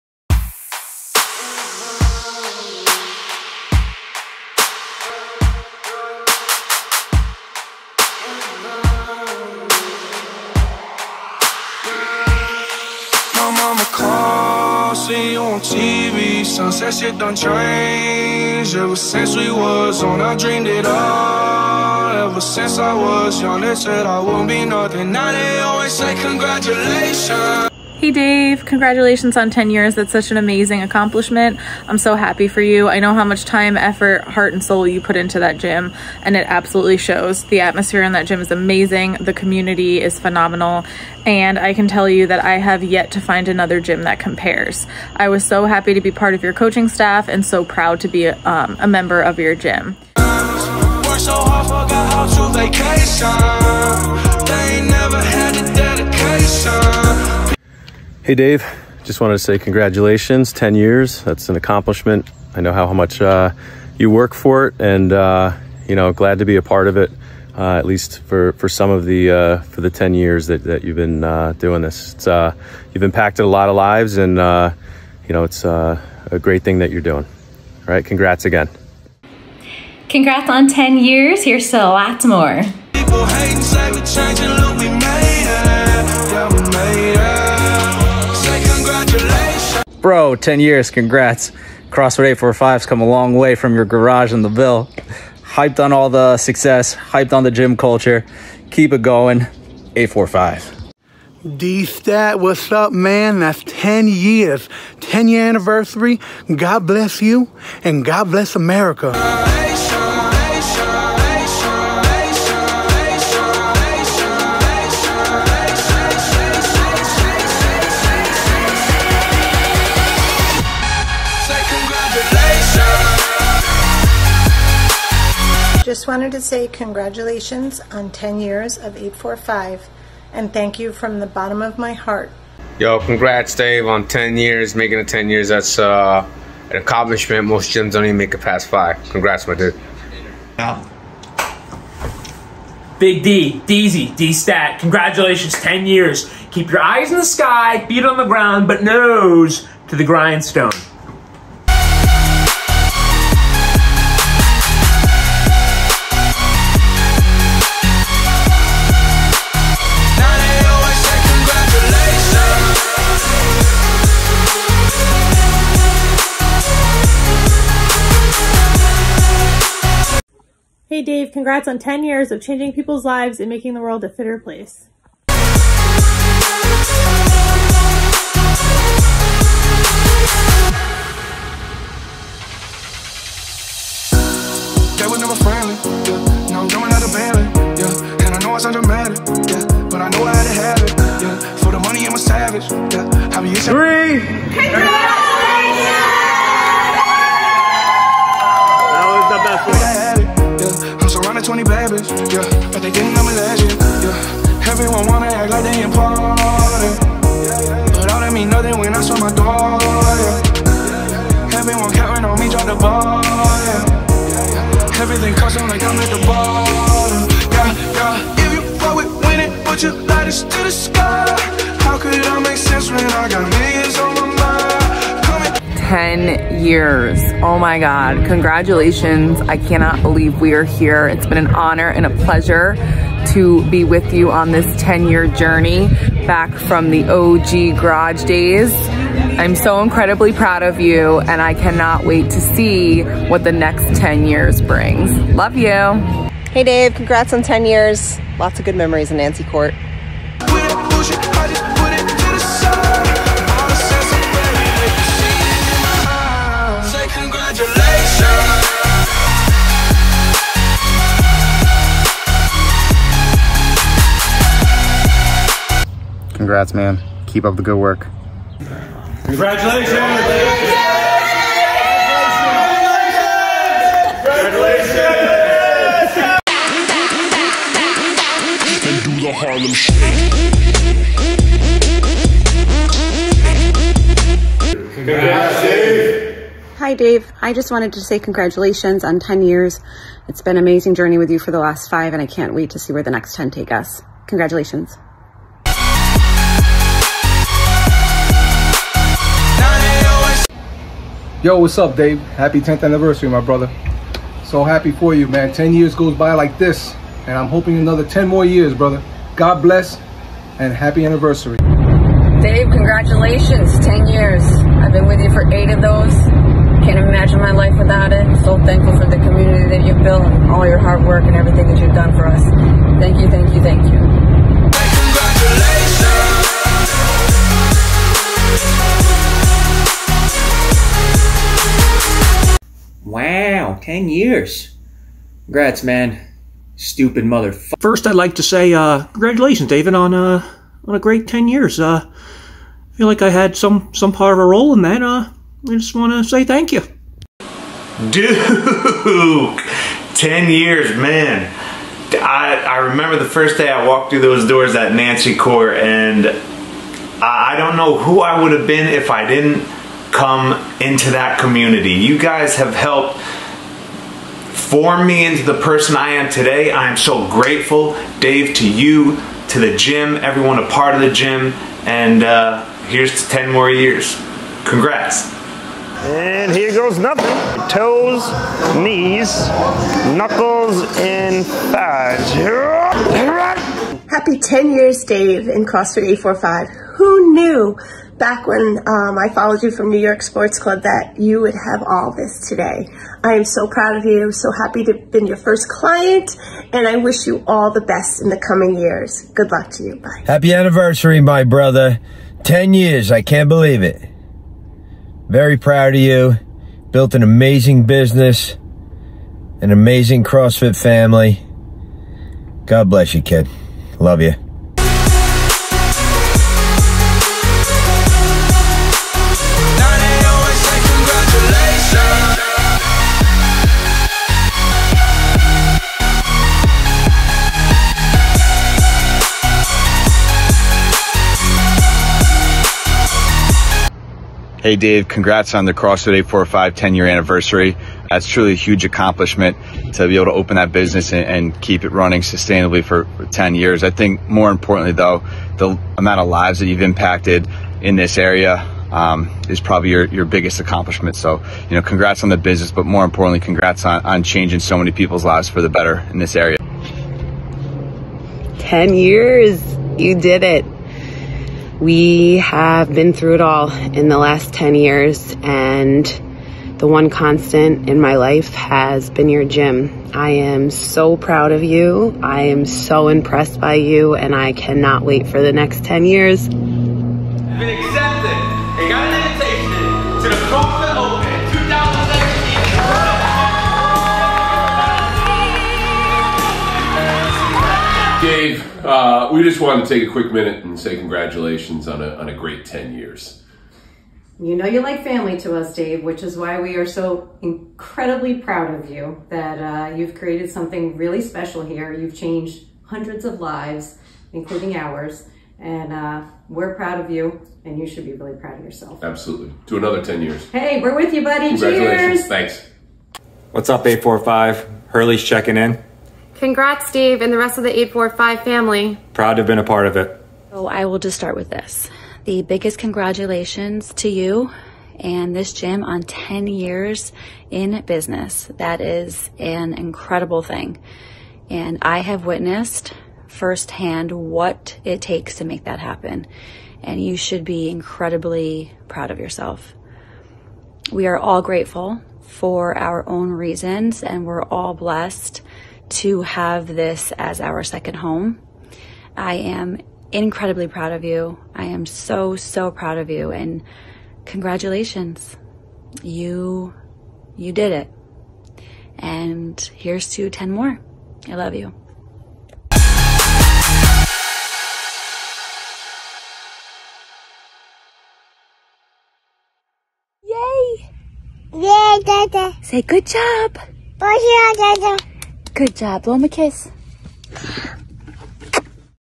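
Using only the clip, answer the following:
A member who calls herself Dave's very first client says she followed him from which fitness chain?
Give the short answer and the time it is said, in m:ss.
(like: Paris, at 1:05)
New York Sports Club, at 6:29.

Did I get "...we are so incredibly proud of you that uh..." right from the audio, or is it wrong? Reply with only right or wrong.
right.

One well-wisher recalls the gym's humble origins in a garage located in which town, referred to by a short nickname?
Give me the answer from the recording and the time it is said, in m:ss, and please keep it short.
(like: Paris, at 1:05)
the Ville, at 1:34.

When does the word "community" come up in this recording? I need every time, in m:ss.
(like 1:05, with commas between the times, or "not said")
0:39, 5:19, 6:01.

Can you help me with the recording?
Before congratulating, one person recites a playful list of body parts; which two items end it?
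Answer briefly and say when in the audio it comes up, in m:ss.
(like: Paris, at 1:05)
knuckles, and thighs, at 6:20.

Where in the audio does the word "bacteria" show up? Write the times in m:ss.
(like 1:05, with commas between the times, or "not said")
not said.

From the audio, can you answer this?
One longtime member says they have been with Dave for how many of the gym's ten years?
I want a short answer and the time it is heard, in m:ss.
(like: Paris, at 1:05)
8, at 5:15.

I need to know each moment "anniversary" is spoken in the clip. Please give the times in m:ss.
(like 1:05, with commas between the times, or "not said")
1:45, 5:02, 5:11, 6:40, 7:17.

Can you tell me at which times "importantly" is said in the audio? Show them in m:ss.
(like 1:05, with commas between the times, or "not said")
7:24, 7:33.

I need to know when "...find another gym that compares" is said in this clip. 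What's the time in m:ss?
0:43.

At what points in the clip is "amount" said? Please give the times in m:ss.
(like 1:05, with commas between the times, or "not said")
7:25.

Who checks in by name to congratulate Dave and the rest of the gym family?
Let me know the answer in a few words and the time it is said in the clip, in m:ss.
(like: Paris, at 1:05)
Hurley, at 8:34.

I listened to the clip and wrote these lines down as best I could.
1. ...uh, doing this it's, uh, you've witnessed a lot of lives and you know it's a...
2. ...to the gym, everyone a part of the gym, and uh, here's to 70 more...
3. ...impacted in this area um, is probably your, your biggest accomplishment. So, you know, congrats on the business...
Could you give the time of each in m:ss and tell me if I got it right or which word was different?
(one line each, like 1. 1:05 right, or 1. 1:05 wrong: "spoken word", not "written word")
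1. 1:11 wrong: "impacted", not "witnessed"
2. 6:09 wrong: "10", not "70"
3. 7:26 right.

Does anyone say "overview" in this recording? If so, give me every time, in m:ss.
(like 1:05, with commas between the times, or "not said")
not said.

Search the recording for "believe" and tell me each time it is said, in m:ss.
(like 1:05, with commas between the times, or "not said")
3:50, 6:43.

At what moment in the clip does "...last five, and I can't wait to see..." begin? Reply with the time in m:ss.
4:51.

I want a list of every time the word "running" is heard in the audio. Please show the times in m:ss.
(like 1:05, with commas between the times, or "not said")
7:21.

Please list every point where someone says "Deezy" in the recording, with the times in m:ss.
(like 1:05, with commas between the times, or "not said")
2:23.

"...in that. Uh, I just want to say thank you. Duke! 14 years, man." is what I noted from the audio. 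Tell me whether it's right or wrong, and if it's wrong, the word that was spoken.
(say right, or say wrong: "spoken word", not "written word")
wrong: "10", not "14".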